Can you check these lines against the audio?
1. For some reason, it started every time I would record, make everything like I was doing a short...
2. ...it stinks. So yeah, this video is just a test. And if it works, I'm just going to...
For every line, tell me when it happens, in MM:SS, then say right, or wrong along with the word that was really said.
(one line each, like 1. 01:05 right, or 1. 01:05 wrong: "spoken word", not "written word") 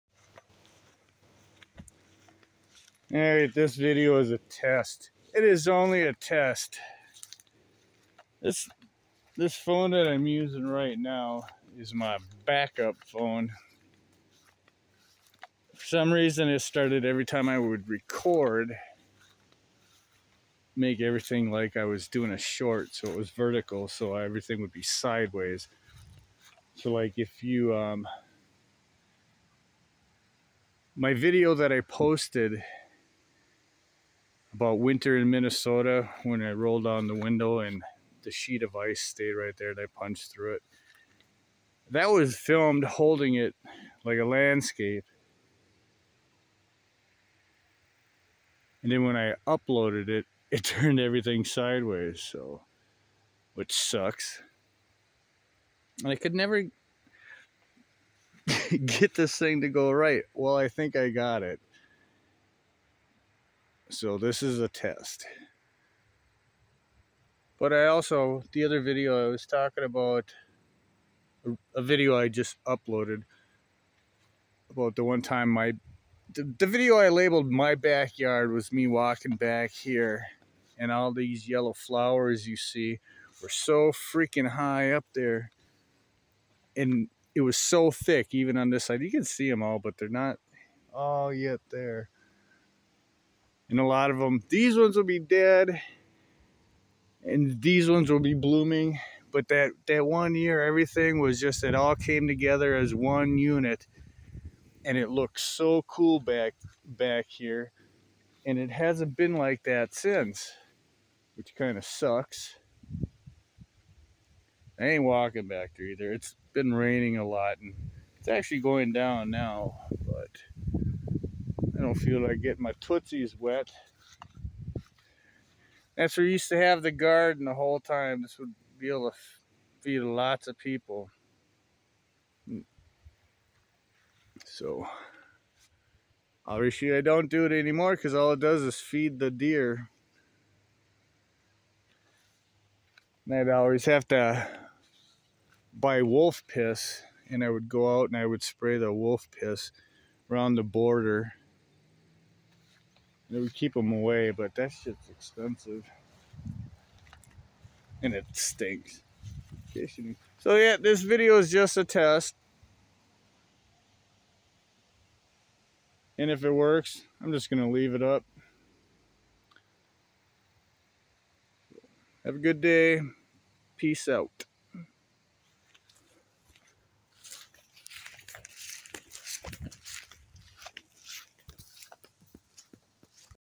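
1. 00:15 right
2. 02:38 right.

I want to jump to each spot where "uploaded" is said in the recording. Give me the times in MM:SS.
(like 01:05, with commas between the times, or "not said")
00:49, 01:12.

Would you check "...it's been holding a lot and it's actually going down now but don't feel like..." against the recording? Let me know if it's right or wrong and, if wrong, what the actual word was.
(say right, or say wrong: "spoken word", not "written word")
wrong: "raining", not "holding".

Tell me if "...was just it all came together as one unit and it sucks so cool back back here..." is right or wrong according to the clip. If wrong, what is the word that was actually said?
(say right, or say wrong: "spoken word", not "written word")
wrong: "looks", not "sucks".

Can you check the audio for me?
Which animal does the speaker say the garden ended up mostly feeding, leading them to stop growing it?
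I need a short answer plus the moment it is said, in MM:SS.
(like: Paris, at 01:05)
Deer, at 02:19.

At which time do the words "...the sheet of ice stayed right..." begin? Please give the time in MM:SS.
00:38.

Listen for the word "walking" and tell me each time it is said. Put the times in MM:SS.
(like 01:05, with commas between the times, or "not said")
01:18, 01:55.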